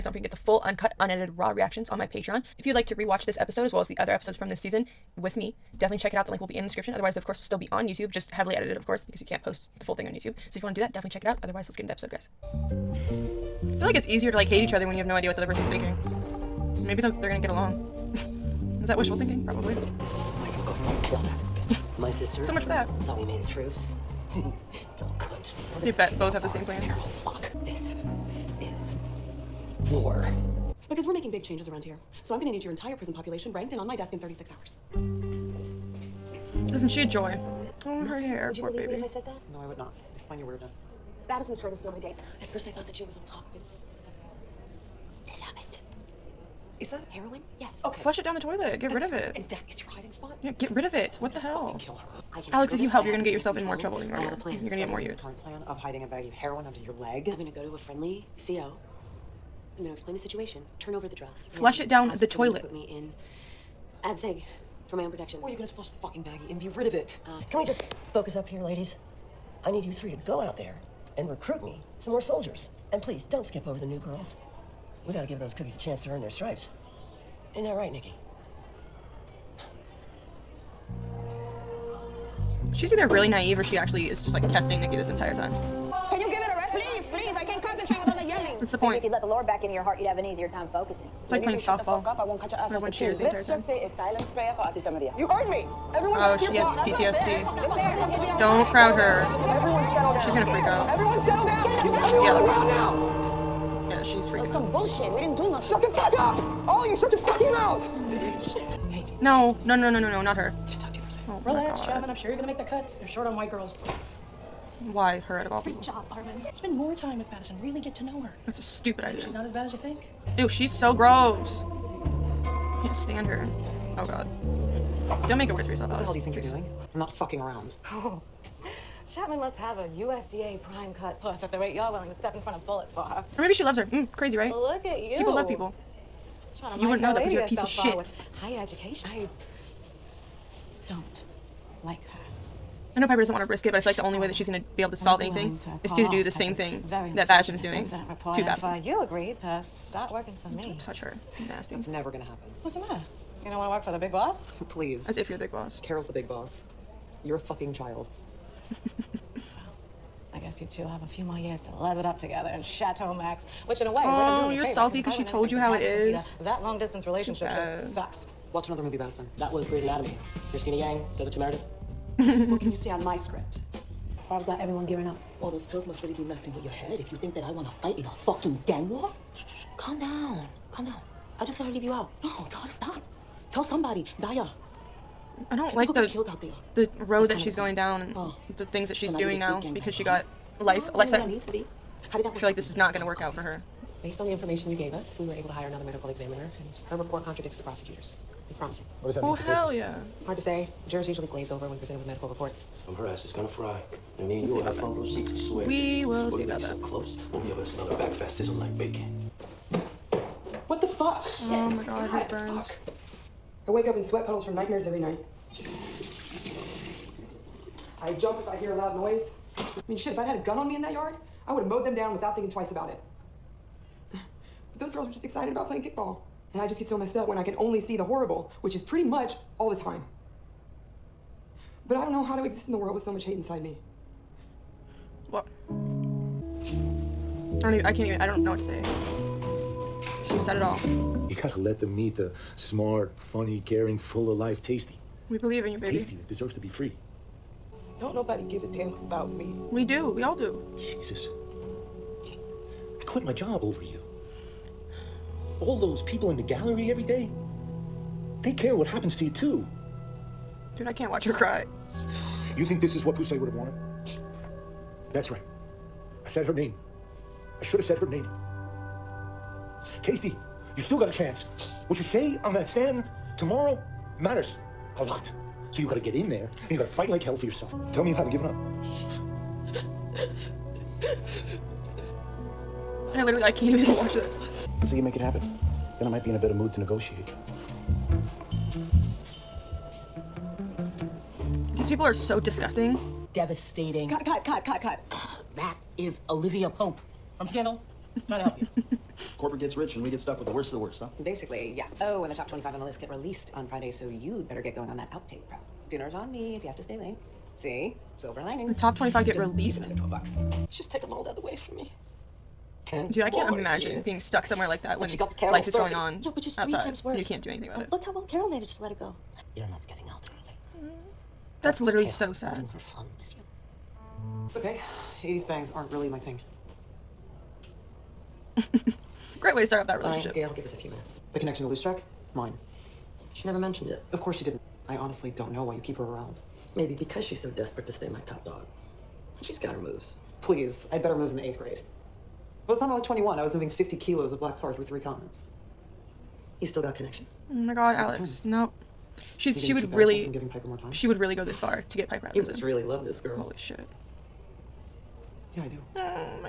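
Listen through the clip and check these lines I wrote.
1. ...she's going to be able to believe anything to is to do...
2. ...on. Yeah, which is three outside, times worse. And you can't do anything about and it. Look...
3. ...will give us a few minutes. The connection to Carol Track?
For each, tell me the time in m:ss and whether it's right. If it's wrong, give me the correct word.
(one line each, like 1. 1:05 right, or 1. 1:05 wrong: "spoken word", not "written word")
1. 2:24 wrong: "solve", not "believe"
2. 5:15 right
3. 5:30 wrong: "Loose", not "Carol".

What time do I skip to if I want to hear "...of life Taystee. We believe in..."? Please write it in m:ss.
4:04.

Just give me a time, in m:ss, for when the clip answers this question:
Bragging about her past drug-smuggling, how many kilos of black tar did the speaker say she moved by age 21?
5:43.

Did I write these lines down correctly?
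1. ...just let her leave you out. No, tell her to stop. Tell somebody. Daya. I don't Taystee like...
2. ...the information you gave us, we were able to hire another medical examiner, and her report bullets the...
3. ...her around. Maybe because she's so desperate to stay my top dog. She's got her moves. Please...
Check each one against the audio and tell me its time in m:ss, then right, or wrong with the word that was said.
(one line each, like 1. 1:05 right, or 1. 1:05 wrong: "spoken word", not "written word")
1. 3:01 wrong: "People", not "Taystee"
2. 3:14 wrong: "contradicts", not "bullets"
3. 5:35 right.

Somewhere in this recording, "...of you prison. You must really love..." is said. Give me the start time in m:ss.
5:52.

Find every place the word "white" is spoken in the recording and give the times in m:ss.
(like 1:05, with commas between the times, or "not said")
1:53.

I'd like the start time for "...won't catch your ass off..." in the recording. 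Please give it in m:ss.
1:32.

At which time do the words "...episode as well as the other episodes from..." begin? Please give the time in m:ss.
0:03.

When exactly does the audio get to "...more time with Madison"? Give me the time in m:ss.
1:56.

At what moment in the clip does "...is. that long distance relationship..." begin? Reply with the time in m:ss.
2:45.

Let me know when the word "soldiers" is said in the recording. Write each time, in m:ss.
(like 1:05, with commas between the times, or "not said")
1:12.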